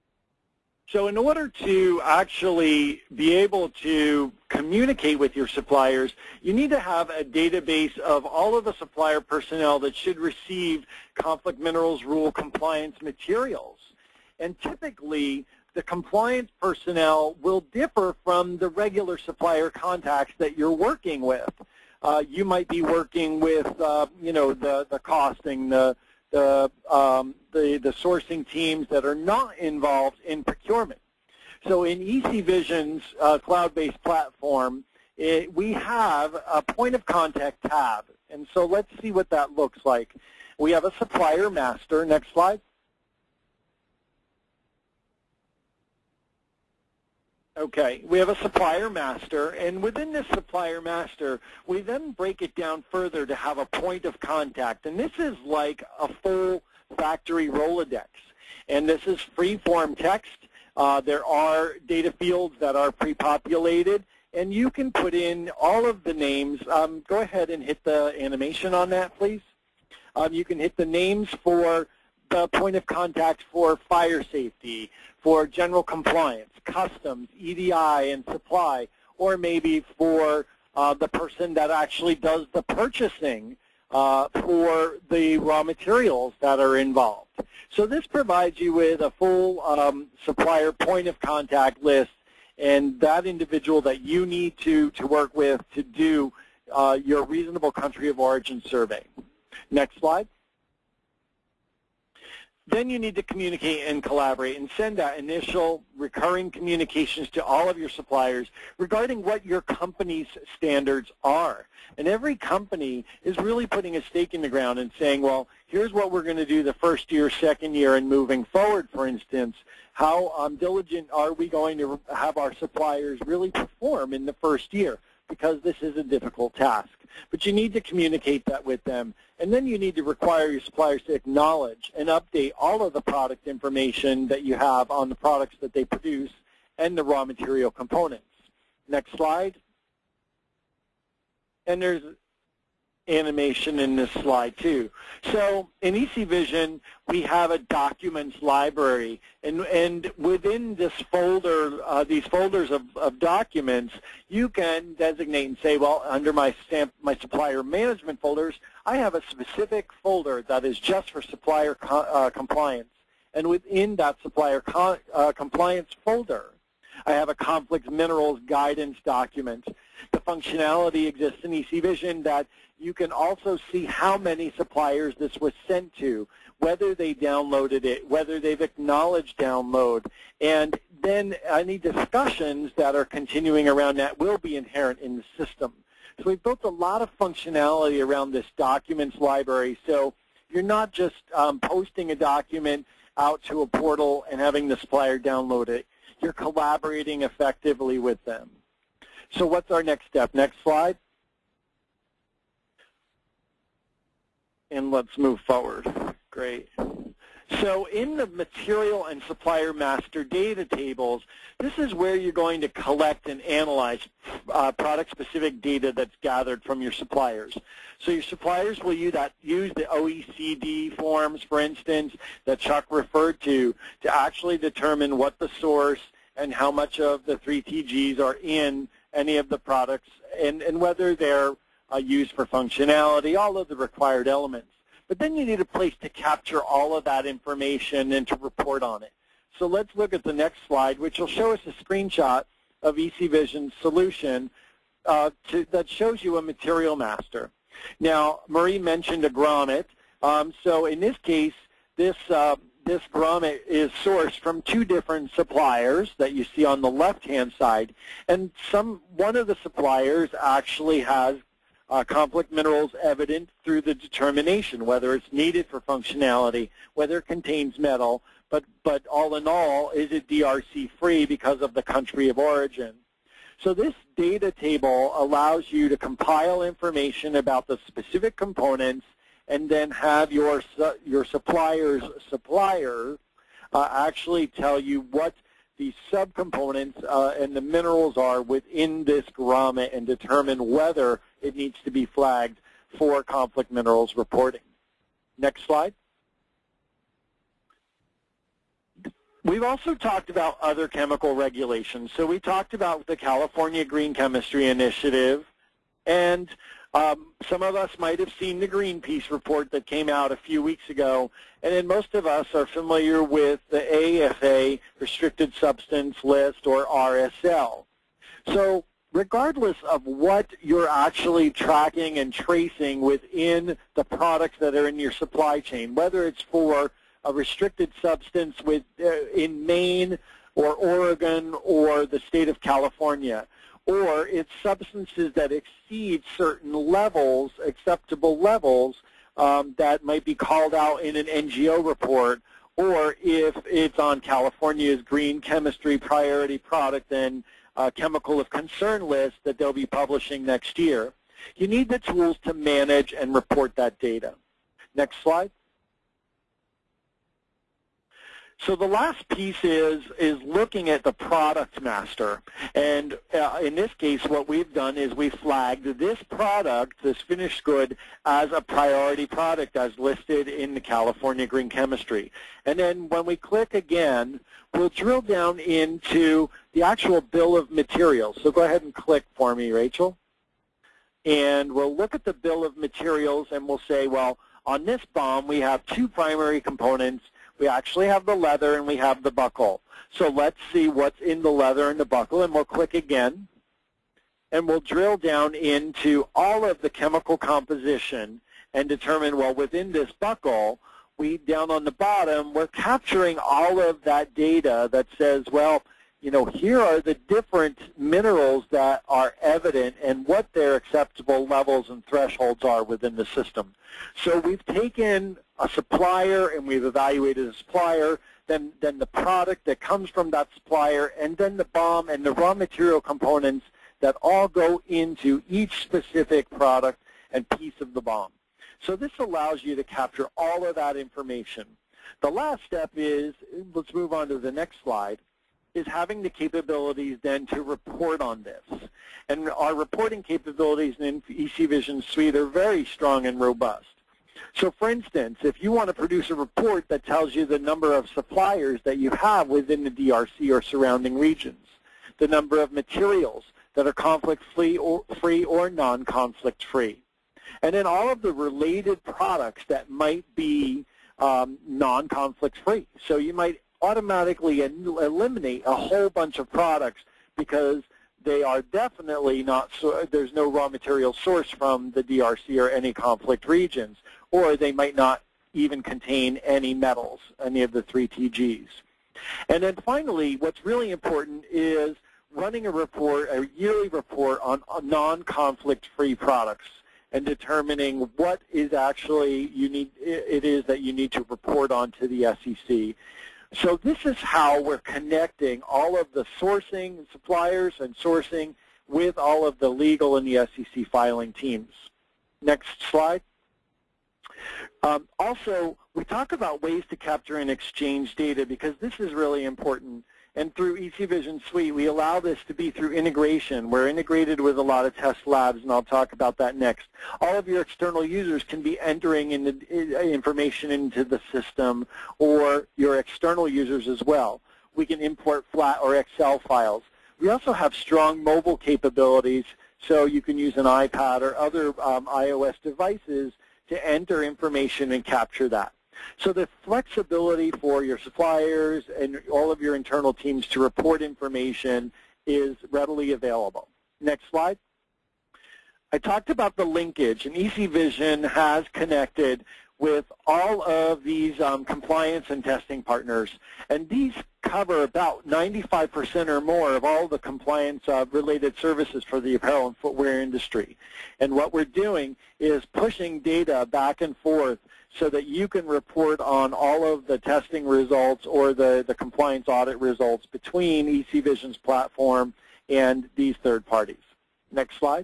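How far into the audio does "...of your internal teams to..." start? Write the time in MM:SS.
08:59.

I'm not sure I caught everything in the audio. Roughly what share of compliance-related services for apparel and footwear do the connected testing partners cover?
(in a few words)
95% or more.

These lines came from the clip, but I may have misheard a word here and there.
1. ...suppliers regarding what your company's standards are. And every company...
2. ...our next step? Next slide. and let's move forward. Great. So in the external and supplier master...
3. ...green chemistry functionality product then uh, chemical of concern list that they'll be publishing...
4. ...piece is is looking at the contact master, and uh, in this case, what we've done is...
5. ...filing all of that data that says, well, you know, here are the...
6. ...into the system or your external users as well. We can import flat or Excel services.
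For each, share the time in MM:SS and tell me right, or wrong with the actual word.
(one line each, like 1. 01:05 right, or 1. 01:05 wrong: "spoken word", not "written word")
1. 01:47 right
2. 03:19 wrong: "material", not "external"
3. 05:45 wrong: "priority", not "functionality"
4. 05:59 wrong: "product", not "contact"
5. 06:42 wrong: "capturing", not "filing"
6. 08:40 wrong: "files", not "services".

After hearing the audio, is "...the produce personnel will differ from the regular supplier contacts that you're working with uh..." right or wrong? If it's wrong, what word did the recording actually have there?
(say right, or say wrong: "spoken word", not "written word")
wrong: "compliance", not "produce".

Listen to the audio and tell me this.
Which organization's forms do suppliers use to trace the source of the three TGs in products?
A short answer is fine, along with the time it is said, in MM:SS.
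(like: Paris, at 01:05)
OECD, at 03:39.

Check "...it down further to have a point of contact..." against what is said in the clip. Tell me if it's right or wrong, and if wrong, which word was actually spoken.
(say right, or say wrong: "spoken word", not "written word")
right.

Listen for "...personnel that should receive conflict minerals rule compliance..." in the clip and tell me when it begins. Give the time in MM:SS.
00:09.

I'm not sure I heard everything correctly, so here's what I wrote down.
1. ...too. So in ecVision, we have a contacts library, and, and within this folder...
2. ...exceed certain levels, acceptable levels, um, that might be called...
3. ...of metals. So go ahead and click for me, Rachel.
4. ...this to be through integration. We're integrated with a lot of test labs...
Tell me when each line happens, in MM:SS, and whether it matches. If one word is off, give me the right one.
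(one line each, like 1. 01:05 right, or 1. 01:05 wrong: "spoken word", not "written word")
1. 02:24 wrong: "documents", not "contacts"
2. 05:35 right
3. 06:17 wrong: "materials", not "metals"
4. 08:32 right.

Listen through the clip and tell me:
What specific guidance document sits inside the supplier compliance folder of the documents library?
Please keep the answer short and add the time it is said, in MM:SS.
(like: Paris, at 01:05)
Conflict minerals guidance document, at 02:47.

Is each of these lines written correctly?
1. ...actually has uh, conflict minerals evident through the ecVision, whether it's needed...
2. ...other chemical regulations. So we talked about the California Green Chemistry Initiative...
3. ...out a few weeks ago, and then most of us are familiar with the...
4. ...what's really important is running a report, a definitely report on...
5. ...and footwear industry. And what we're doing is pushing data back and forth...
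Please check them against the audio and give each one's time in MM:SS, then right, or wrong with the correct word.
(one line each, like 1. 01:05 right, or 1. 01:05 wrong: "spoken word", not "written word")
1. 04:20 wrong: "determination", not "ecVision"
2. 05:00 right
3. 05:10 right
4. 08:00 wrong: "yearly", not "definitely"
5. 09:19 right.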